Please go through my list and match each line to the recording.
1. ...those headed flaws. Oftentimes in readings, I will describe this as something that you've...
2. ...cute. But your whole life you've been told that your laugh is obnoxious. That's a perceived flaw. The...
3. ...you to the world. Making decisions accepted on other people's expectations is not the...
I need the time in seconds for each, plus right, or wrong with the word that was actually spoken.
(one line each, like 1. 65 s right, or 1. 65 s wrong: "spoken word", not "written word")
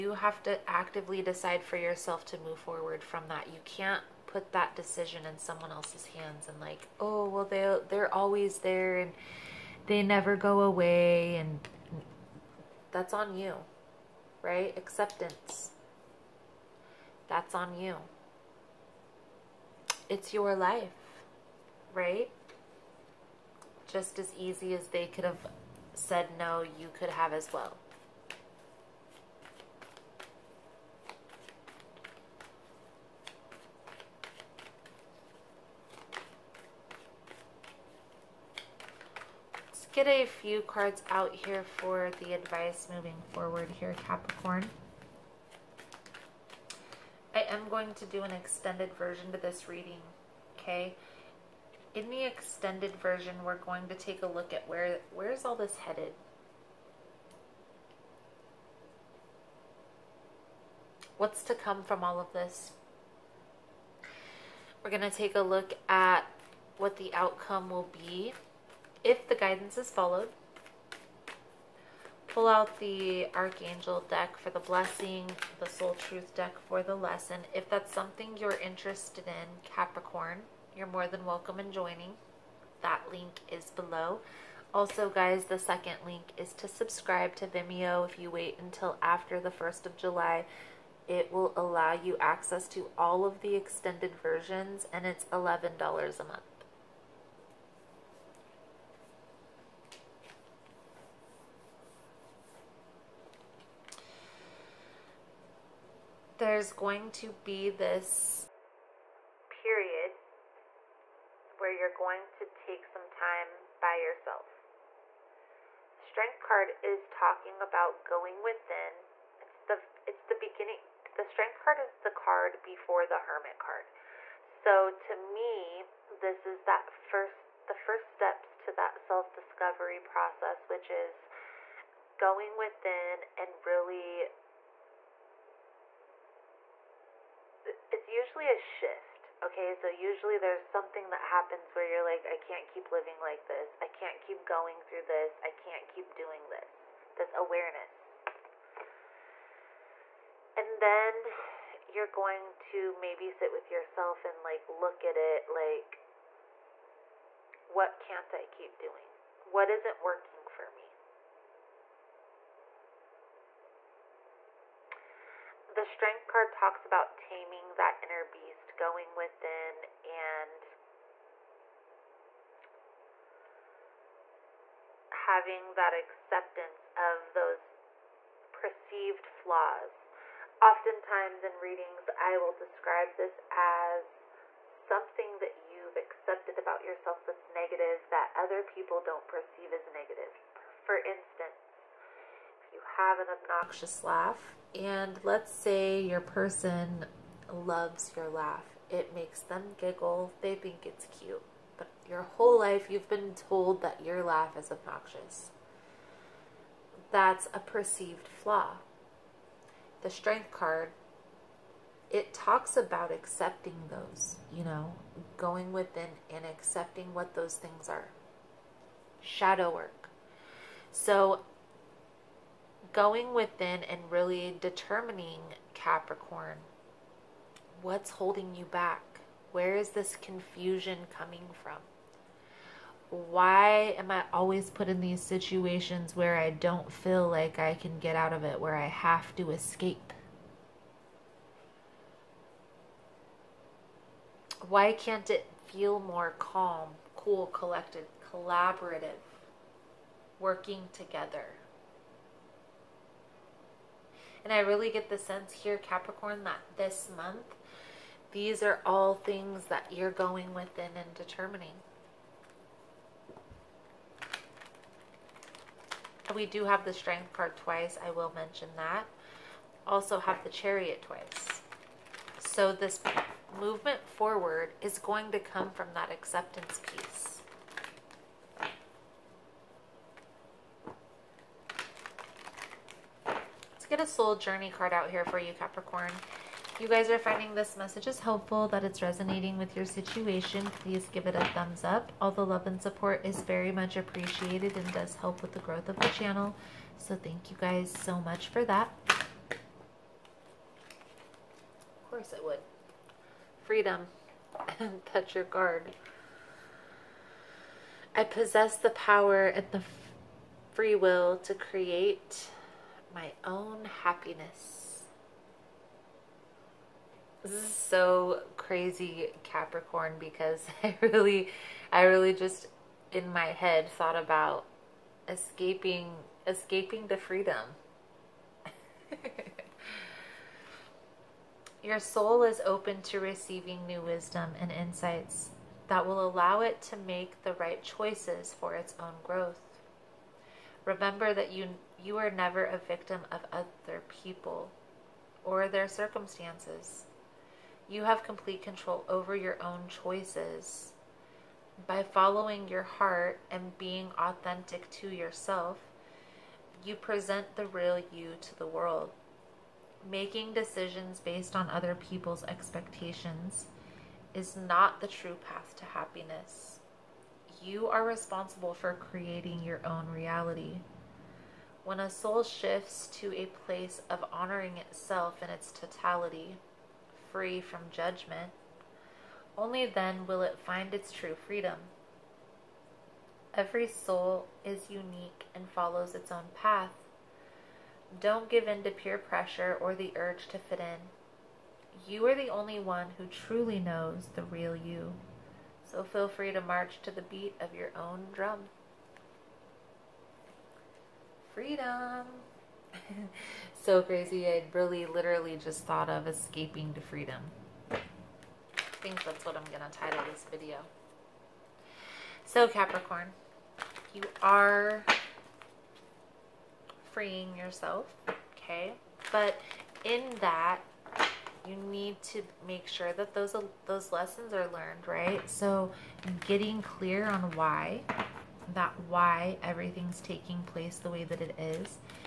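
1. 177 s wrong: "perceived", not "headed"
2. 201 s right
3. 358 s wrong: "based", not "accepted".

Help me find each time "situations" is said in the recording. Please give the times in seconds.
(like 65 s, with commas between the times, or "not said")
235 s, 289 s.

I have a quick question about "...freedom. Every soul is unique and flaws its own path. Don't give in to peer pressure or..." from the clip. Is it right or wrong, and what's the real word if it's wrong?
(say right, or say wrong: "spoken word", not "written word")
wrong: "follows", not "flaws".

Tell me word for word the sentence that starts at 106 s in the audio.
there's going to be this period where you're going to take some time by yourself.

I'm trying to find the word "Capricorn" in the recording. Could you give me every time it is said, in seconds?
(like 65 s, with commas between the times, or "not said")
44 s, 79 s, 225 s, 255 s, 285 s, 319 s, 412 s.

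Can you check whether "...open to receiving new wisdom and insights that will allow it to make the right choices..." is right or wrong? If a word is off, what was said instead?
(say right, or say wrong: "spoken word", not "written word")
right.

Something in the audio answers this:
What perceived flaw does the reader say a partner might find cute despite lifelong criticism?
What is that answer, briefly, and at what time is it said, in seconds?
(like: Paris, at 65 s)
Obnoxious laugh, at 193 s.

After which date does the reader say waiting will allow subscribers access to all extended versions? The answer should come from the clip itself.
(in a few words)
1st of July.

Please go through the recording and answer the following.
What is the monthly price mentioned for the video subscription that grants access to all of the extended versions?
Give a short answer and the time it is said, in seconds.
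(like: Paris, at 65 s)
$11, at 95 s.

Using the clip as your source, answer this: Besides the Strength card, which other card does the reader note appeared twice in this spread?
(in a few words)
Chariot.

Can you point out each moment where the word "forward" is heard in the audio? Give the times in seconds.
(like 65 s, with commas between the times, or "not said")
2 s, 43 s, 274 s.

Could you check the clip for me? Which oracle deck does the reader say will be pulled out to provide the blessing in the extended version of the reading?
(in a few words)
Archangel deck.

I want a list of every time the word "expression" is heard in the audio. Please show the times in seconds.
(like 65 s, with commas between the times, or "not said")
not said.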